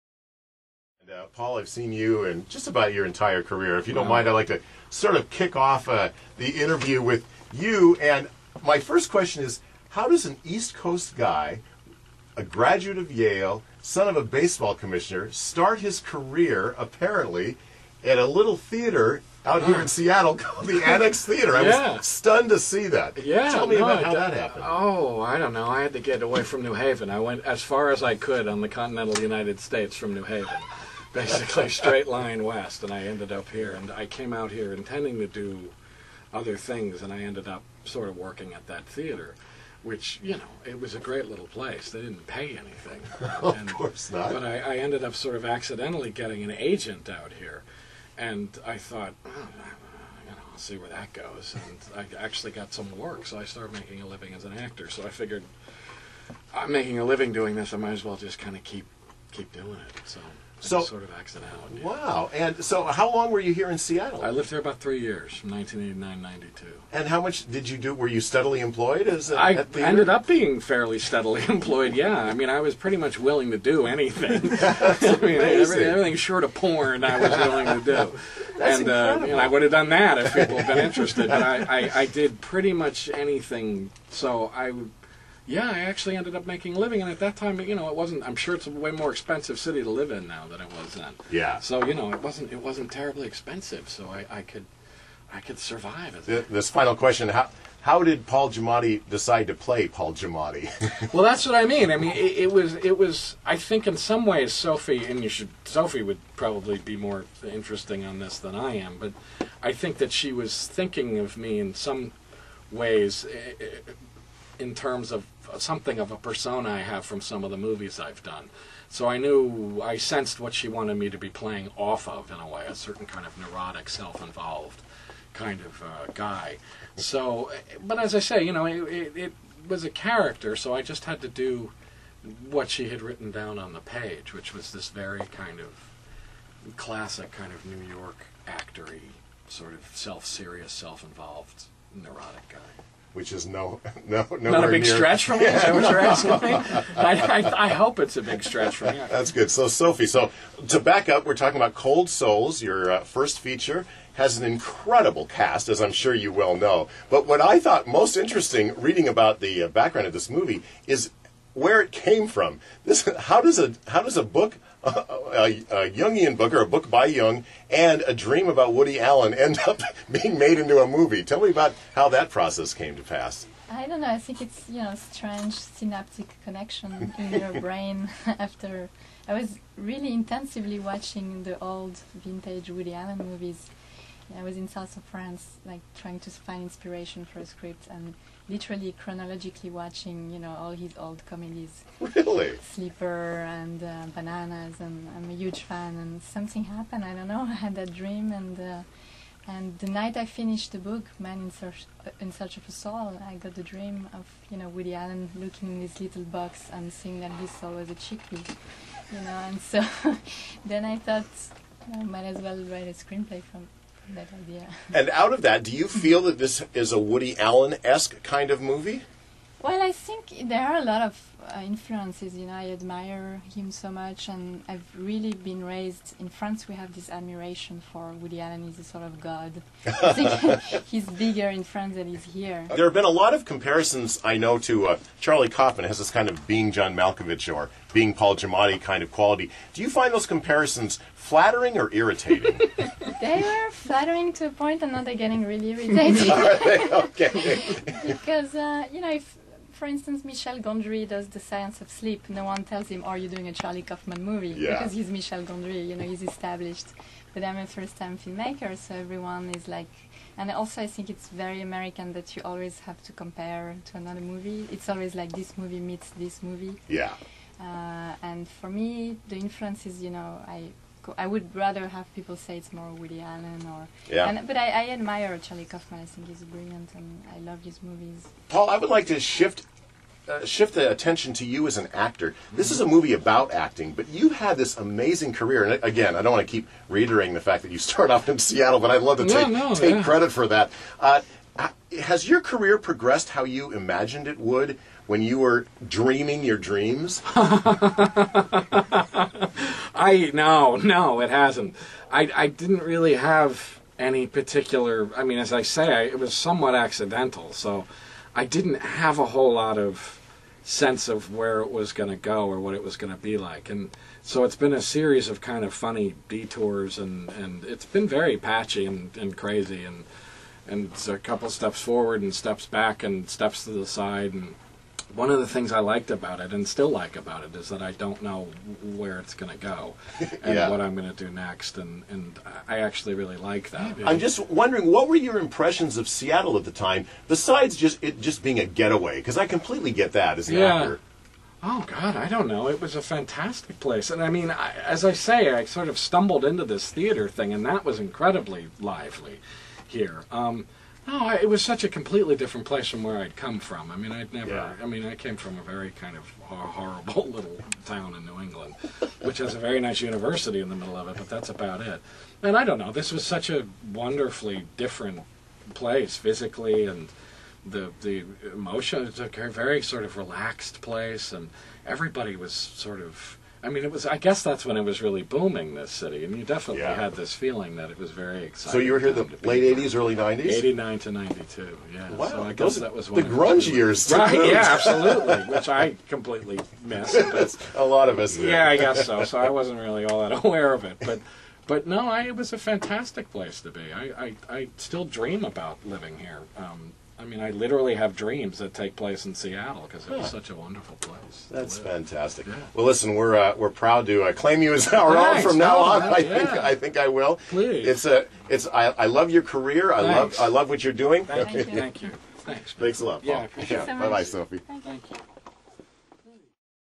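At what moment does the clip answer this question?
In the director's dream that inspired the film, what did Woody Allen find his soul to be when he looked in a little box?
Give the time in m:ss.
3:27.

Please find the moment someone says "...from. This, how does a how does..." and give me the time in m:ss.
2:42.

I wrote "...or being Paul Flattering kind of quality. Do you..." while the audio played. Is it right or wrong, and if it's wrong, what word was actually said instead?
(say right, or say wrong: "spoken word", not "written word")
wrong: "Giamatti", not "Flattering".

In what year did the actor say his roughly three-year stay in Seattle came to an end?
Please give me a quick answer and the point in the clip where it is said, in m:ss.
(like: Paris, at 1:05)
1992, at 1:06.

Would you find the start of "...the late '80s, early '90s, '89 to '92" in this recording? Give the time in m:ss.
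6:19.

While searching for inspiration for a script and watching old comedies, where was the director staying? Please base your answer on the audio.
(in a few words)
South of France.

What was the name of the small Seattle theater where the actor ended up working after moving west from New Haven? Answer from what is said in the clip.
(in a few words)
Annex Theater.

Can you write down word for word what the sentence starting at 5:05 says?
I mean, as I say, I, it was somewhat accidental.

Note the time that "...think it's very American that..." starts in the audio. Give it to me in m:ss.
4:20.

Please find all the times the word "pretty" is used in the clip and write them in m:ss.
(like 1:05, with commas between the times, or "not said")
1:12, 1:22.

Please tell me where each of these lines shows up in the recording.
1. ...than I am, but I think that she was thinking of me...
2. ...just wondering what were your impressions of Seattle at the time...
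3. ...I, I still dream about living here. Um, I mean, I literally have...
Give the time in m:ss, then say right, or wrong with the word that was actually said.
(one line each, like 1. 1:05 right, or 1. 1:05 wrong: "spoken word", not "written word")
1. 1:48 right
2. 5:34 right
3. 6:34 right.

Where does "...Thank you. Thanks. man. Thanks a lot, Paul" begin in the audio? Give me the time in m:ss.
6:51.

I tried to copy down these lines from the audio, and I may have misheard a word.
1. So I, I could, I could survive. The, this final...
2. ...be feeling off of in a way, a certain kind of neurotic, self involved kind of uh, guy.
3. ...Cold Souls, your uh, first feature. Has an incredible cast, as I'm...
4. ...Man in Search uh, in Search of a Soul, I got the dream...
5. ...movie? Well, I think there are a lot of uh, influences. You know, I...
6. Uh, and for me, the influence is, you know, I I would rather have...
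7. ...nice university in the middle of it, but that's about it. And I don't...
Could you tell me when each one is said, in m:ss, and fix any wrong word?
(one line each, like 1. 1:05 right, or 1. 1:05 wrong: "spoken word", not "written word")
1. 1:33 right
2. 2:01 wrong: "playing", not "feeling"
3. 2:31 right
4. 3:21 right
5. 3:38 right
6. 4:27 right
7. 5:59 right.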